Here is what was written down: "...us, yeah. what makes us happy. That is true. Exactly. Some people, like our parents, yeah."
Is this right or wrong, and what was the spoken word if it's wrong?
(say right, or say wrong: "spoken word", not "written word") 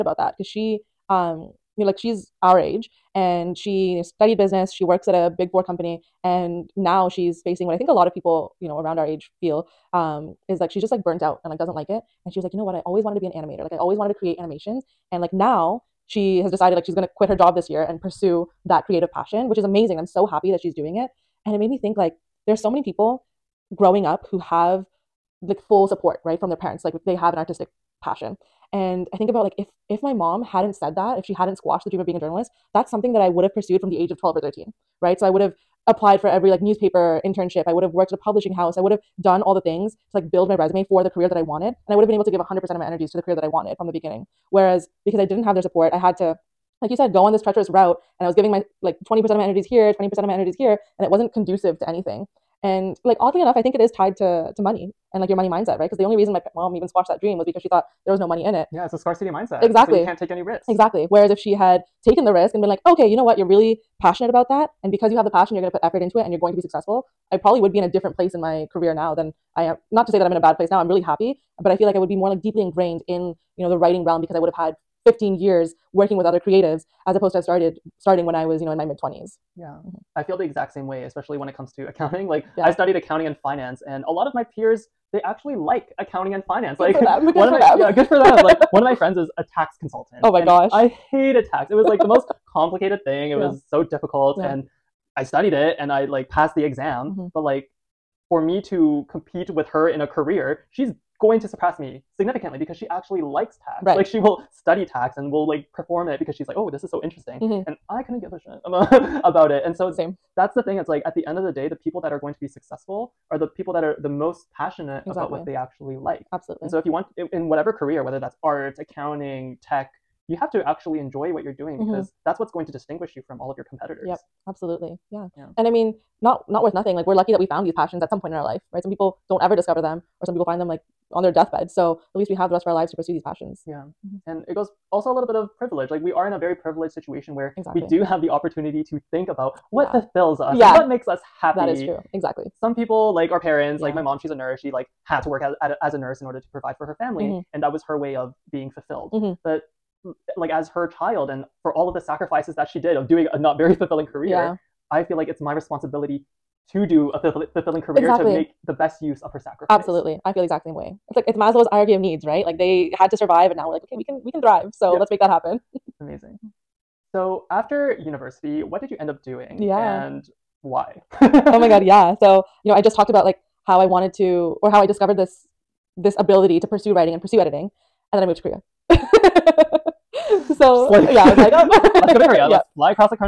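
right.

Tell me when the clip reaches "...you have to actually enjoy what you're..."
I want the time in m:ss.
2:00.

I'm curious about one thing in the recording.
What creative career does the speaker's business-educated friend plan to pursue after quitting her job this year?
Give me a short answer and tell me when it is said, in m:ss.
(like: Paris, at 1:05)
Animator, at 0:13.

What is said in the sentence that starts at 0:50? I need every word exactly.
And it wasn't conducive to anything.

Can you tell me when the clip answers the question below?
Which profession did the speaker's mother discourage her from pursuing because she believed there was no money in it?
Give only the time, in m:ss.
0:32.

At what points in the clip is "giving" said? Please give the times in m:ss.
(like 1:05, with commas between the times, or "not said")
0:48.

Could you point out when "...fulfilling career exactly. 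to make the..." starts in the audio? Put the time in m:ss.
2:37.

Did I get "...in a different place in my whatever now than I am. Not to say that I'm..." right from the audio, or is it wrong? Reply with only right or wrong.
wrong.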